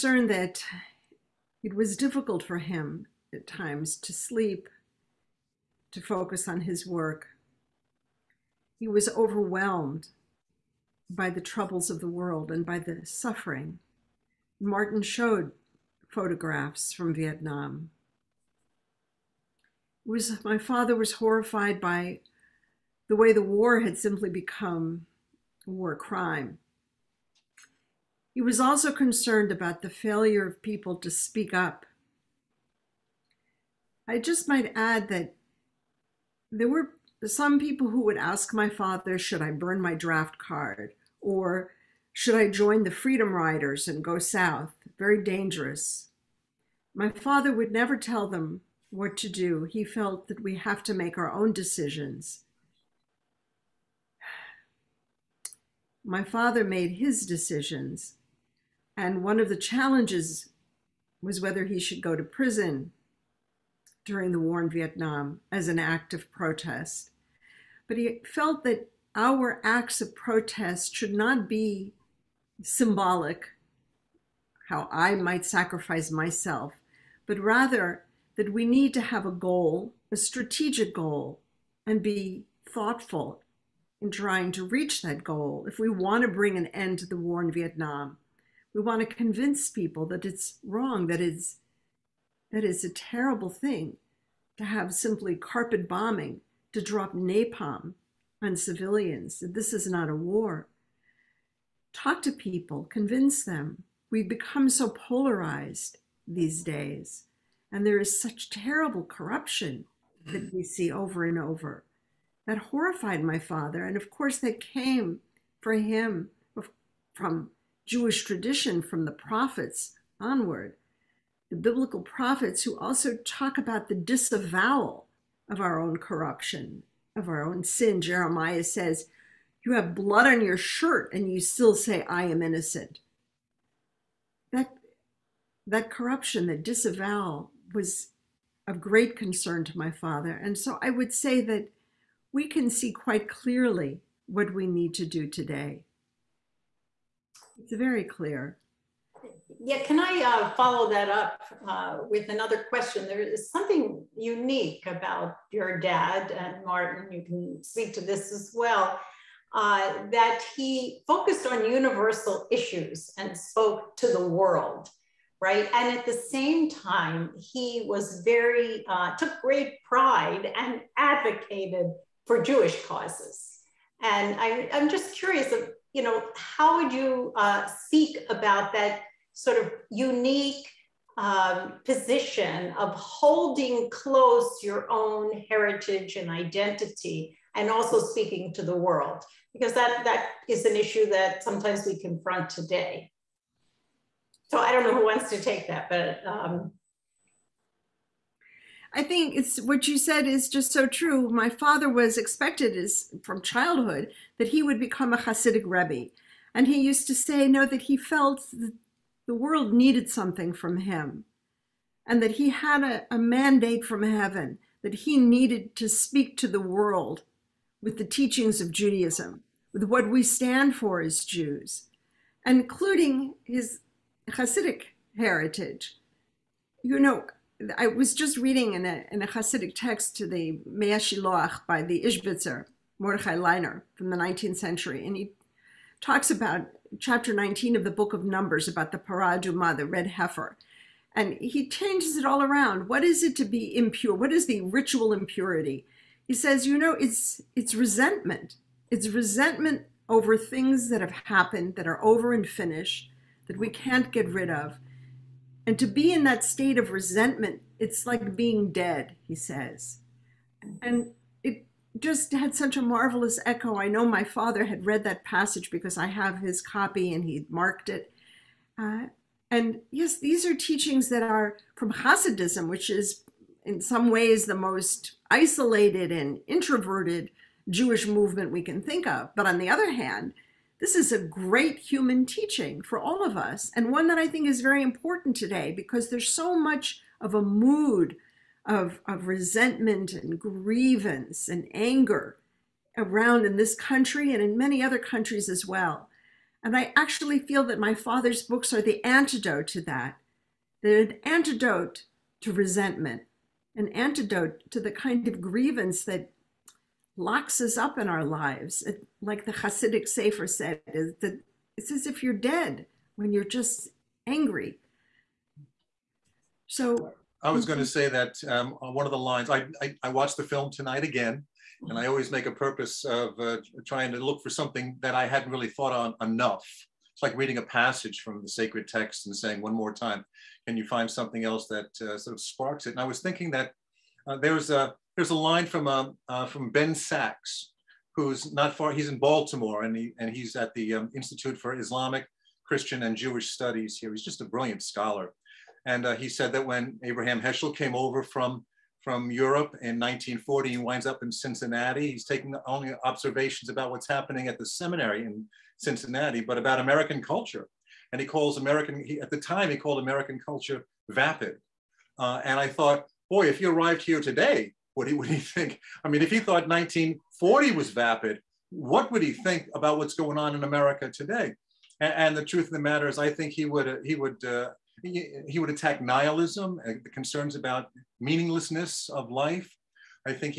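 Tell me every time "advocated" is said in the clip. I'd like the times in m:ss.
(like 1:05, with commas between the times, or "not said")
2:50.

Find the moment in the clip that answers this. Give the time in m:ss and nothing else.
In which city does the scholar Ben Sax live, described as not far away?
5:39.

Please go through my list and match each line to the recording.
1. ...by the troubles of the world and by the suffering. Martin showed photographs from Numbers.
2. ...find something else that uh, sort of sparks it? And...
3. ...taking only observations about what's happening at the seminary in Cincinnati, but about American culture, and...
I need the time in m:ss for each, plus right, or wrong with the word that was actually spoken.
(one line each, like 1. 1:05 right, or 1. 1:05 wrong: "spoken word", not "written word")
1. 0:11 wrong: "Vietnam", not "Numbers"
2. 5:30 right
3. 5:52 right.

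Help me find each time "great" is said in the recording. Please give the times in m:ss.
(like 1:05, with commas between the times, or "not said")
2:18, 2:49, 4:41.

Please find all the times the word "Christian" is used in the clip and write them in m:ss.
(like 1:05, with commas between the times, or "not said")
5:42.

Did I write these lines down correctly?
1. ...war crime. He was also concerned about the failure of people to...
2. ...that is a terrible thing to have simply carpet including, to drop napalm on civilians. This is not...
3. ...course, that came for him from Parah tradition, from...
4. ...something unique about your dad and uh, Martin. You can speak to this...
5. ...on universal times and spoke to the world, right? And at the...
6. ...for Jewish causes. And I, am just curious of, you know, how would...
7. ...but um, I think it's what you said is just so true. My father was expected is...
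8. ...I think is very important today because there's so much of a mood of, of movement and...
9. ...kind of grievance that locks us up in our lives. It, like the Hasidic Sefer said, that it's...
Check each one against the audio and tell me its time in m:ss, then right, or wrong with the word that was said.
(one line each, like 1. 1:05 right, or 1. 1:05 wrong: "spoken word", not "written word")
1. 0:25 right
2. 1:32 wrong: "bombing", not "including"
3. 1:54 wrong: "Jewish", not "Parah"
4. 2:33 right
5. 2:41 wrong: "issues", not "times"
6. 2:52 right
7. 3:15 right
8. 4:44 wrong: "resentment", not "movement"
9. 5:04 right.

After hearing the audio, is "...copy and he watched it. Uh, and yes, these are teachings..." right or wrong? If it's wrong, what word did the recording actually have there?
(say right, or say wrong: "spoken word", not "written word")
wrong: "marked", not "watched".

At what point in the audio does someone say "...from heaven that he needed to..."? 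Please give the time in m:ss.
3:33.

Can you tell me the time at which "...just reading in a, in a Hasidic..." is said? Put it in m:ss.
3:48.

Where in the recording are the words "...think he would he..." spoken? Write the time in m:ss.
6:13.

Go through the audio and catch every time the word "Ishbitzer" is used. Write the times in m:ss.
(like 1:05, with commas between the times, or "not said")
3:52.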